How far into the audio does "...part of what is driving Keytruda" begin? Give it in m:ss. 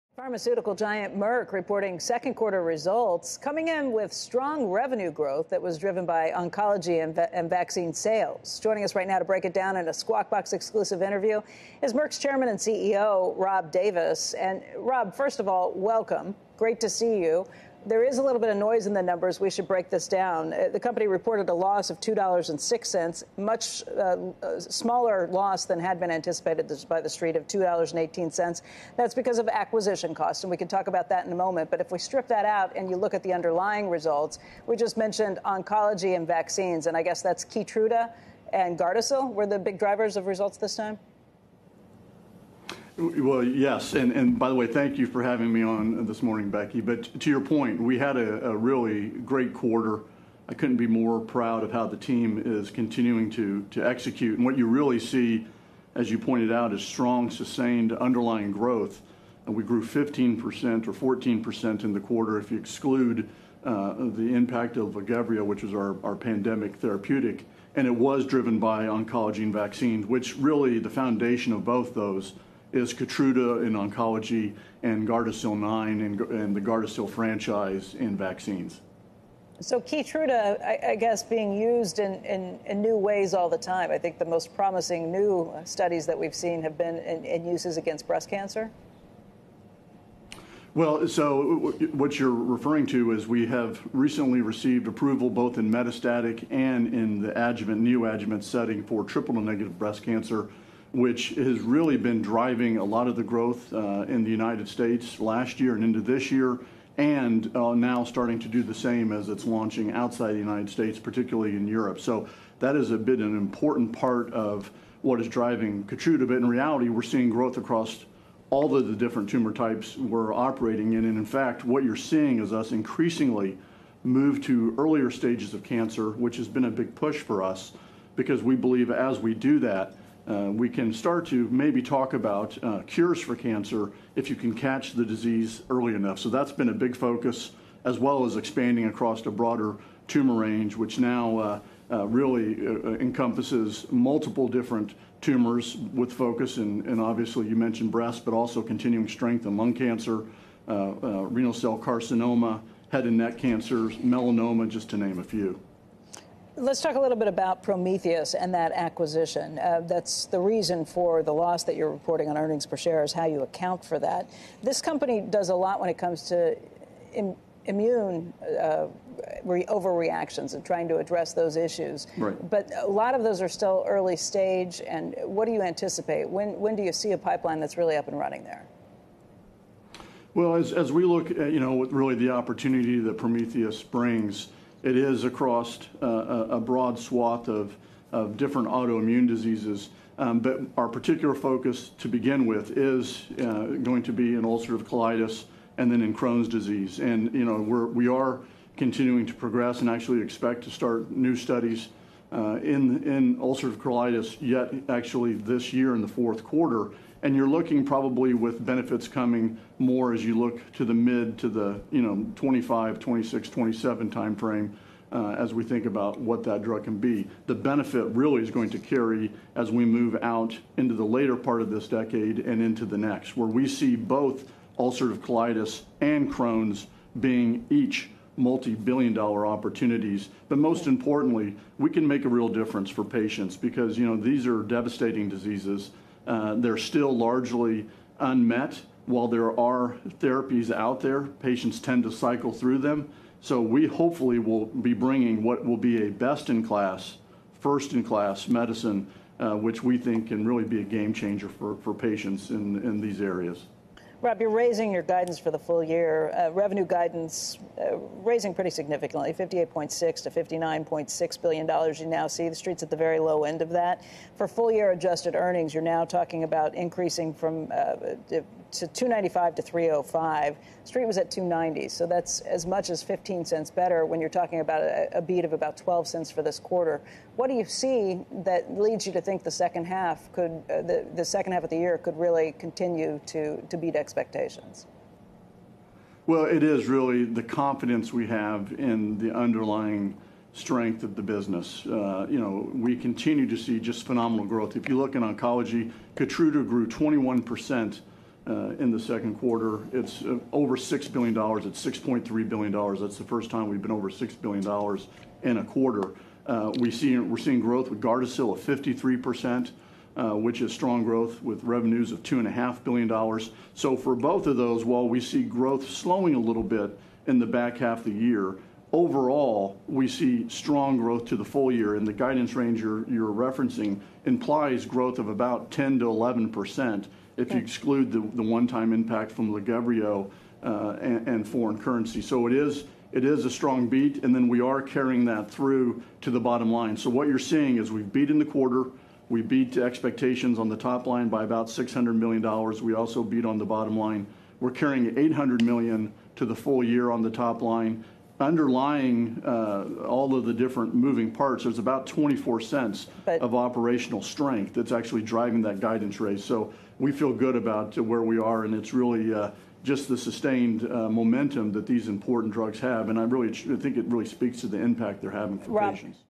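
1:53.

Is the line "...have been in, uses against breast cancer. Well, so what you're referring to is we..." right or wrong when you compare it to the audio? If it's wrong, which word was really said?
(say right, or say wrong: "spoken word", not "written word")
right.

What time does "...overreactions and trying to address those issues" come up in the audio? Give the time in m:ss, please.
2:49.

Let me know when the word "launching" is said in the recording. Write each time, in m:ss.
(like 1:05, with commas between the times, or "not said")
1:49.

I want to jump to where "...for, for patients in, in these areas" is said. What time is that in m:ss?
4:11.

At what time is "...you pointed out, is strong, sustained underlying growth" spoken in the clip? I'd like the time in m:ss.
0:56.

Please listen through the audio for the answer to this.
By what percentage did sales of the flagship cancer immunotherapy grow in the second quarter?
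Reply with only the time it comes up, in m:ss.
4:56.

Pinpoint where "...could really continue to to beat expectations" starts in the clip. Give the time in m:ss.
4:41.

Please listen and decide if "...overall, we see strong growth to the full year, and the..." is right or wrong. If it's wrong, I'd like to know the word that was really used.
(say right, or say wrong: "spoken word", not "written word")
right.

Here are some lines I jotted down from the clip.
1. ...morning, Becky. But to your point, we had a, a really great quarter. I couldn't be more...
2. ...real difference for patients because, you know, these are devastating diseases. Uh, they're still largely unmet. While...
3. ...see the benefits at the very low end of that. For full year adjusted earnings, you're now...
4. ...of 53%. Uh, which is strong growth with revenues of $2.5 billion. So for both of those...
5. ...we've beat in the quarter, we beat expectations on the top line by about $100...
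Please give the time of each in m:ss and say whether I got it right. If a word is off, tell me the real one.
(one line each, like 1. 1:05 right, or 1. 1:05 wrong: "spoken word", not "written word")
1. 0:46 right
2. 3:52 right
3. 4:22 wrong: "streets", not "benefits"
4. 5:08 right
5. 5:37 wrong: "600", not "100".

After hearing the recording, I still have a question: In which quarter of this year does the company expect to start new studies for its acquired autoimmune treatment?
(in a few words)
fourth quarter.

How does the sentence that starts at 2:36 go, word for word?
Let's talk a little bit about Prometheus and that acquisition.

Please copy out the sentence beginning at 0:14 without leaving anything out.
And Rob, first of all, welcome.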